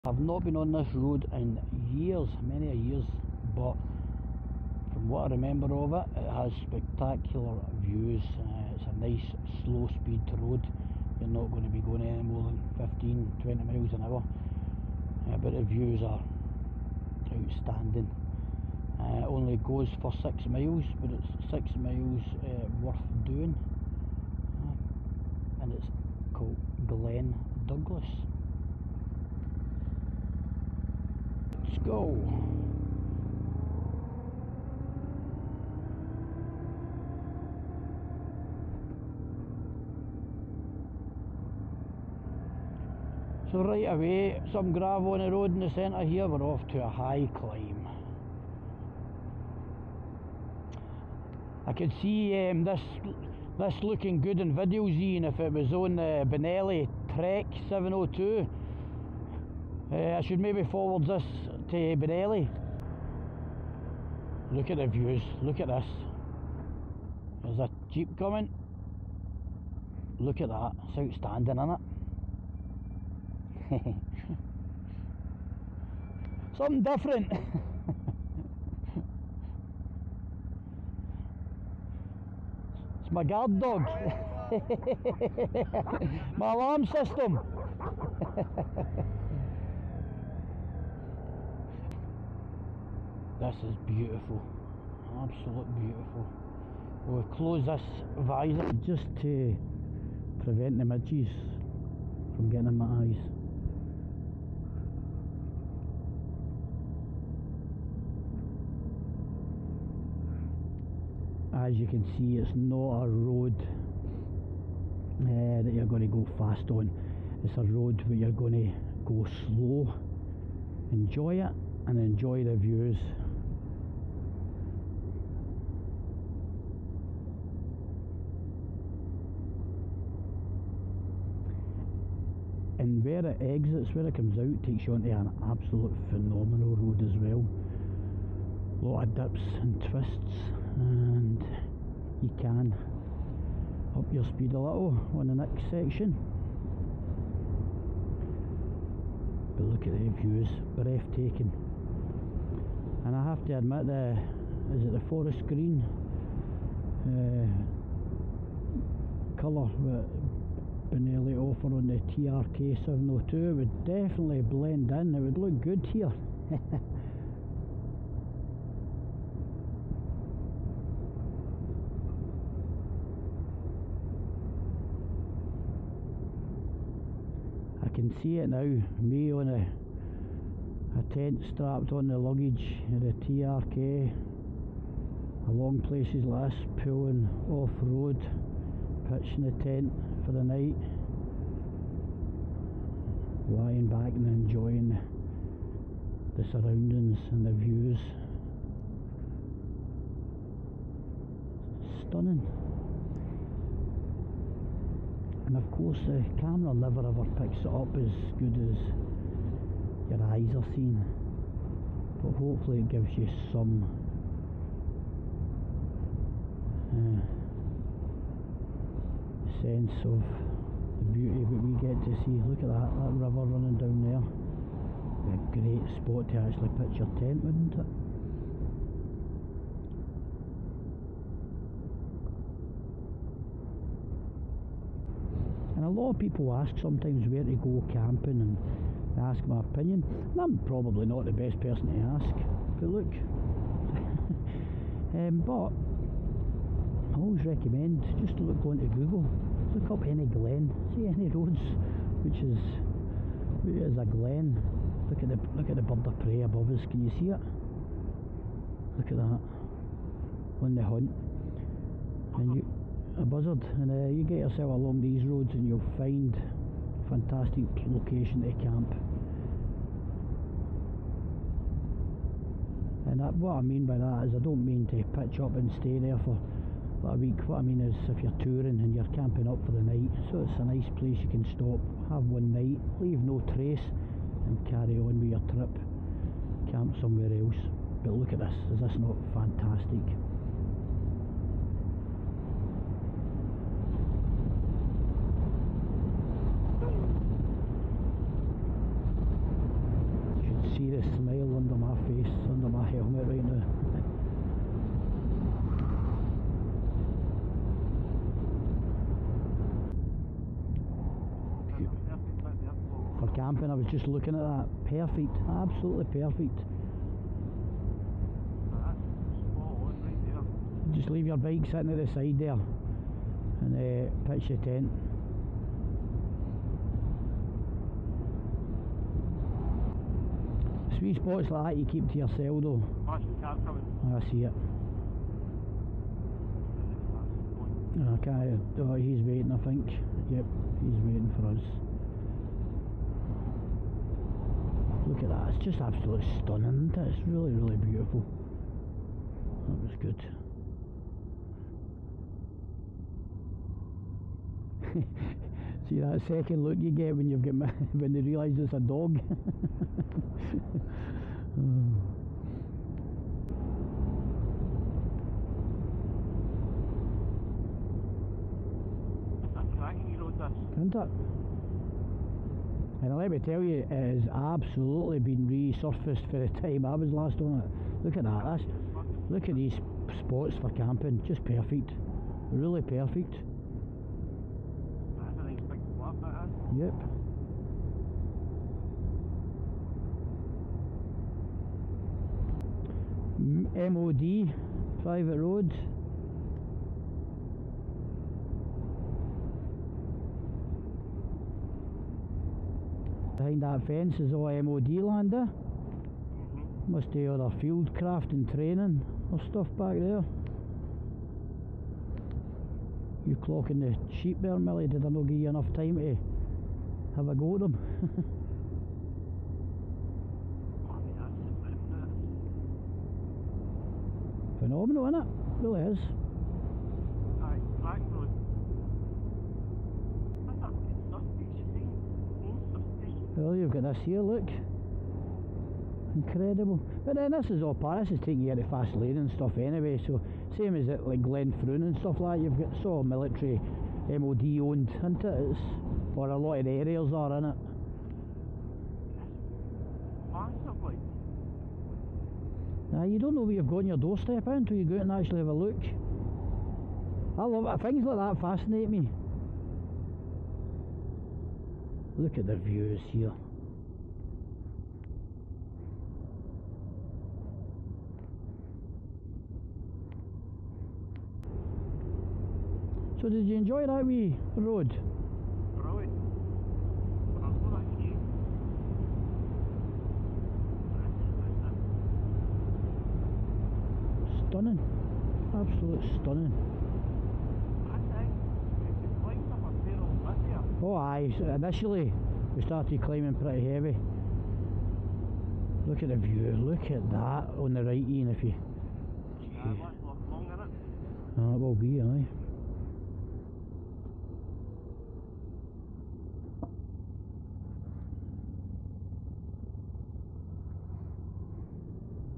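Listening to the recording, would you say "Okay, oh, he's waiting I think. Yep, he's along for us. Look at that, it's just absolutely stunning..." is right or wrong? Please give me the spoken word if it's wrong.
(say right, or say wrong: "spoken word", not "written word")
wrong: "waiting", not "along".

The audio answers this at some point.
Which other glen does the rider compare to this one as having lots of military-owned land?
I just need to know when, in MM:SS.
07:21.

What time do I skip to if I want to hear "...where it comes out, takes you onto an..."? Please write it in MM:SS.
02:13.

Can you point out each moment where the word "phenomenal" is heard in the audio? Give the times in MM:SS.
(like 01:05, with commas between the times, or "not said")
02:16, 07:04.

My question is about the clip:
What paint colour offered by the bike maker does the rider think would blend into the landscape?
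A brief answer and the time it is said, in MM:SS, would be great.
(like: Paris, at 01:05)
forest green, at 02:35.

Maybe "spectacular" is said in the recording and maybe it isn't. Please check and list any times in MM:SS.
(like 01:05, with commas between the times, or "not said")
00:06.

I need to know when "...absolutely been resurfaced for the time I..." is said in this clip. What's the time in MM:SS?
06:14.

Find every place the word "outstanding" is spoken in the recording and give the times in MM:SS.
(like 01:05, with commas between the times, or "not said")
00:17, 01:11.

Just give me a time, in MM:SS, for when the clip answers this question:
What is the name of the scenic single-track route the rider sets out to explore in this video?
00:26.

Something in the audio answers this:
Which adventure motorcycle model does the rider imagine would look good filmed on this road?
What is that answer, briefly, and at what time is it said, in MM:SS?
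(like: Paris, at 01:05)
Benelli Trek 702, at 00:56.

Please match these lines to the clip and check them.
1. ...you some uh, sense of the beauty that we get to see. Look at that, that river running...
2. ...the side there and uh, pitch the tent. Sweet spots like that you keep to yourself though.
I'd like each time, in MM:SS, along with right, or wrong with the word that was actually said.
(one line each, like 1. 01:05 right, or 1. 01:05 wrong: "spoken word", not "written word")
1. 03:33 right
2. 05:22 right.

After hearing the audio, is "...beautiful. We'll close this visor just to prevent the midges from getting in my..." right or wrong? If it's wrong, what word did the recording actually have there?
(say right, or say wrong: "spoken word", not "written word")
right.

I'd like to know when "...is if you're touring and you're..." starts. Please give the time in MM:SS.
04:37.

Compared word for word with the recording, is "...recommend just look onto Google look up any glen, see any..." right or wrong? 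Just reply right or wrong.
right.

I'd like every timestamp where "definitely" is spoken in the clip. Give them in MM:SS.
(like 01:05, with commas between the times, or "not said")
02:43.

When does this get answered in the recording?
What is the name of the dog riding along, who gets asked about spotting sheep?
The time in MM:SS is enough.
06:54.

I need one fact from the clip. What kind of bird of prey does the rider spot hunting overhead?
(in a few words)
buzzard.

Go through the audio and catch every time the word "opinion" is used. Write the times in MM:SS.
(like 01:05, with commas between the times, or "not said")
03:59.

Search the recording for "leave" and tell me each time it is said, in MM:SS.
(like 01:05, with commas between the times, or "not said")
04:43, 05:21.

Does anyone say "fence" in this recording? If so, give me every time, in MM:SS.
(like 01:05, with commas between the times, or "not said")
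06:43.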